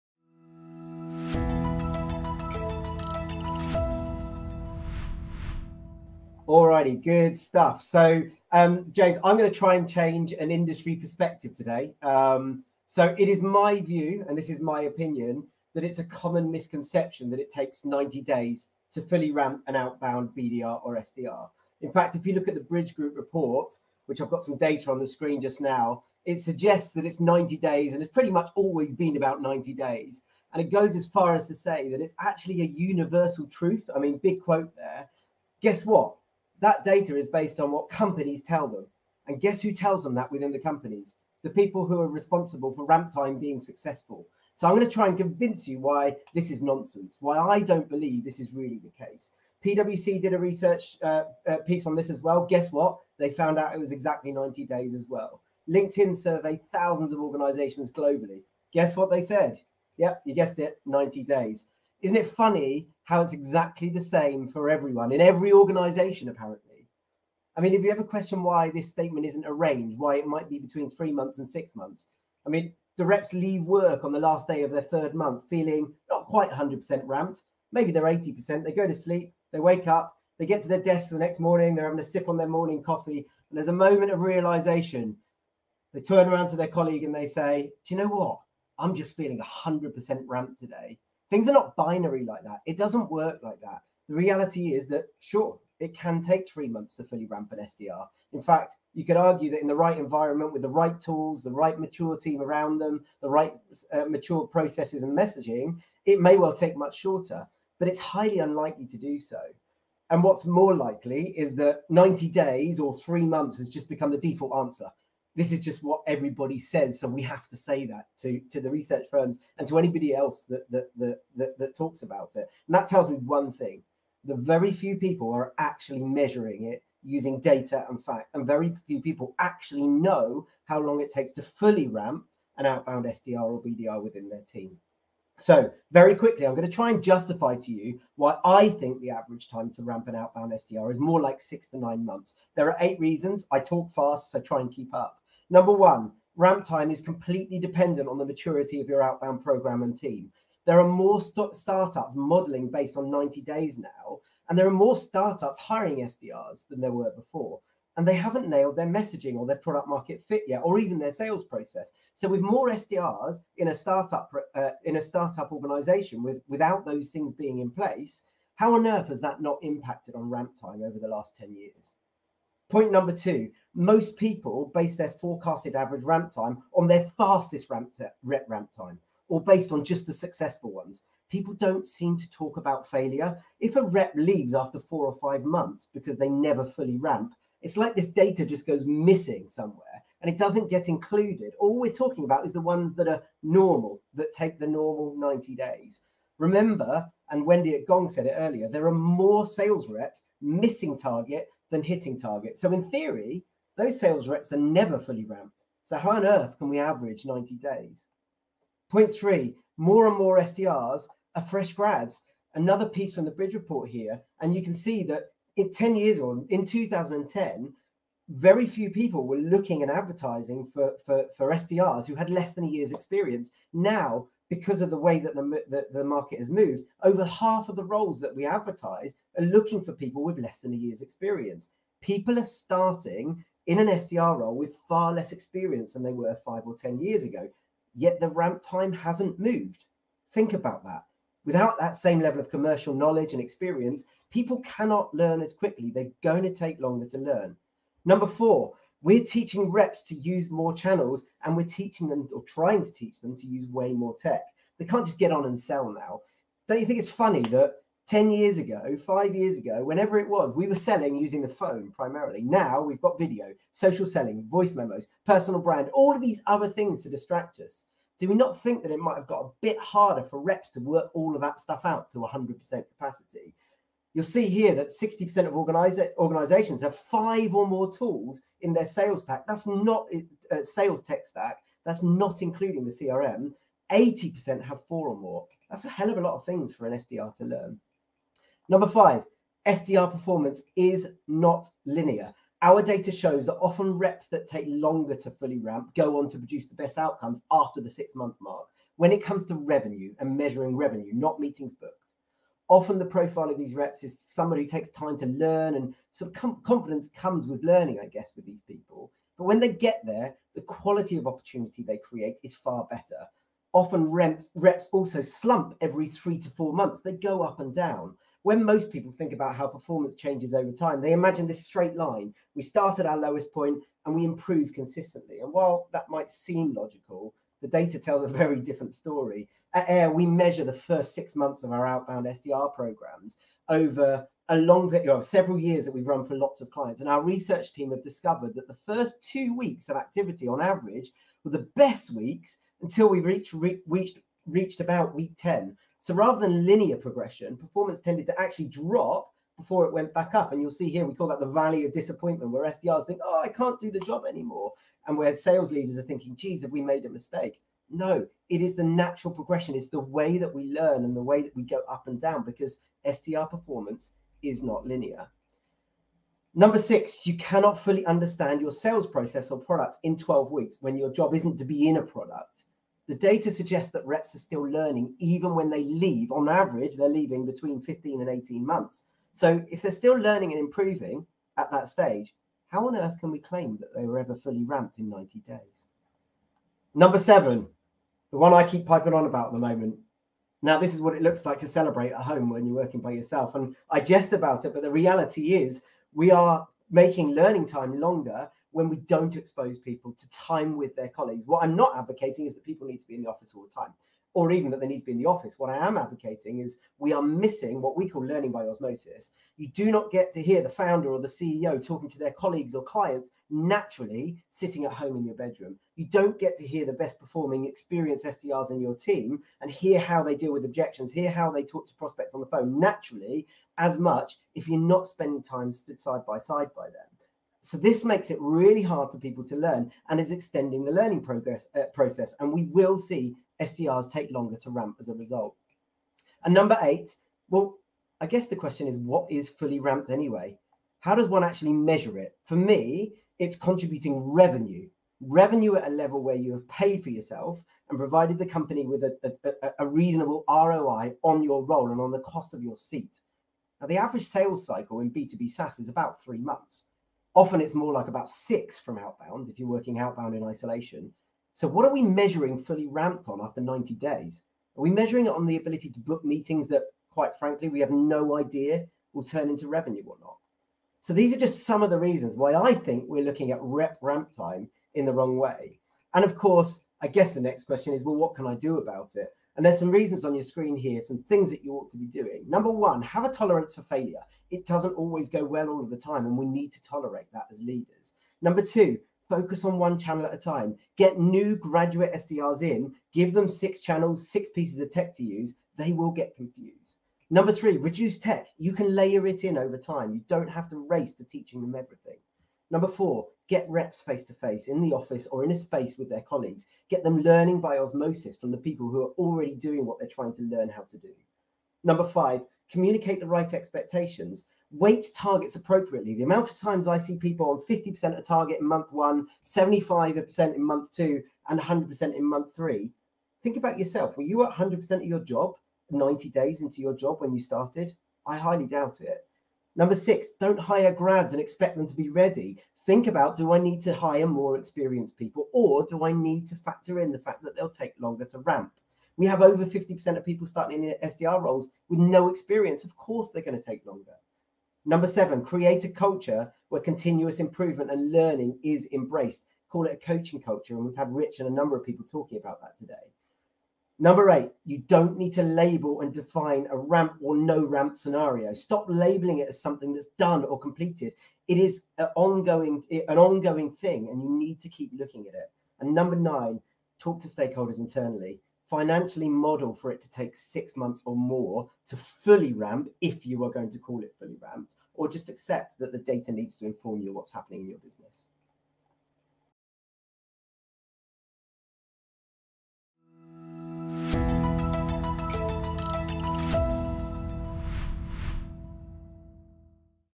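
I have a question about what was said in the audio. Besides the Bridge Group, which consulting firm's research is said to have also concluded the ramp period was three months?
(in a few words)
PwC.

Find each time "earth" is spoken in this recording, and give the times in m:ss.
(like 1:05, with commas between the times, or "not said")
2:48, 3:26, 6:22.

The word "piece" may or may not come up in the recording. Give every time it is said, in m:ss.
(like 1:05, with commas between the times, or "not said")
0:51, 3:32, 8:14.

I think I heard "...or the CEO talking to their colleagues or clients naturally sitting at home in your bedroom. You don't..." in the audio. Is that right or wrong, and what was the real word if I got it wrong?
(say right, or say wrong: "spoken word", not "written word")
right.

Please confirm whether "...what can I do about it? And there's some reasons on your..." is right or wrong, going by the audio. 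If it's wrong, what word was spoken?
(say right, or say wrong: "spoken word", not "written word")
right.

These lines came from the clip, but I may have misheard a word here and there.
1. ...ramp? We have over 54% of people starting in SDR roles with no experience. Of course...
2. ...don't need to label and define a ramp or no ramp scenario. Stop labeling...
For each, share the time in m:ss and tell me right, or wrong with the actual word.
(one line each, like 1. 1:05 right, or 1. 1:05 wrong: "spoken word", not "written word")
1. 8:58 wrong: "50", not "54"
2. 9:14 right.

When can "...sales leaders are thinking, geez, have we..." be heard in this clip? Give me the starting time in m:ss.
5:55.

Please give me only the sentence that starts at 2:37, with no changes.
And they haven't nailed their messaging or their product market fit yet, or even their sales process.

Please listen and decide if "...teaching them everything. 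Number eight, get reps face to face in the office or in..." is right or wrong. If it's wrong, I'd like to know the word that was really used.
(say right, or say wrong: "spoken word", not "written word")
wrong: "four", not "eight".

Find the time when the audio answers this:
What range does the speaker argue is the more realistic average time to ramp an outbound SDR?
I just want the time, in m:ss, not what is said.
2:21.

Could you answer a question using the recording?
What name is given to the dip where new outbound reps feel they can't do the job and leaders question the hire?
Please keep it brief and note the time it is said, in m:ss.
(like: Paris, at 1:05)
valley of disappointment, at 5:51.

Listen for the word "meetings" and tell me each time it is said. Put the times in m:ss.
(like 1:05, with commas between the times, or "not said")
5:01, 7:46.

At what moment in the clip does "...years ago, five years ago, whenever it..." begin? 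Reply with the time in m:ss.
4:18.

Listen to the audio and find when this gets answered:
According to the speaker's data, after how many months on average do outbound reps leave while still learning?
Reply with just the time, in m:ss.
6:17.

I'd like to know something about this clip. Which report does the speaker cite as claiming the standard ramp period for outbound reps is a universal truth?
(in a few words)
Bridge Group report.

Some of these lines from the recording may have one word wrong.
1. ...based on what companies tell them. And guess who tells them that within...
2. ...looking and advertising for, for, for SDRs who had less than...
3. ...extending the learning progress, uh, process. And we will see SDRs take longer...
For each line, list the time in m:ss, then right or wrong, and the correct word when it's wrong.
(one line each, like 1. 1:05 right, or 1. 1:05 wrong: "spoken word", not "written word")
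1. 0:37 right
2. 3:39 right
3. 7:10 right.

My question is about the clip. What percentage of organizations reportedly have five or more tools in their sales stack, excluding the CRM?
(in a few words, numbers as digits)
60%.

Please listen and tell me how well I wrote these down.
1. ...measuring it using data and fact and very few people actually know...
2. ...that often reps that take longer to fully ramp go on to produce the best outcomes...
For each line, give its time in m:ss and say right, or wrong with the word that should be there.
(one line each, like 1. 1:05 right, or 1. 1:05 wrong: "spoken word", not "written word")
1. 2:06 right
2. 4:53 right.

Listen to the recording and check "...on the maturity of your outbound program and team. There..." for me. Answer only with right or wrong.
right.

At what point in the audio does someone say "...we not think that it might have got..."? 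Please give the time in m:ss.
4:28.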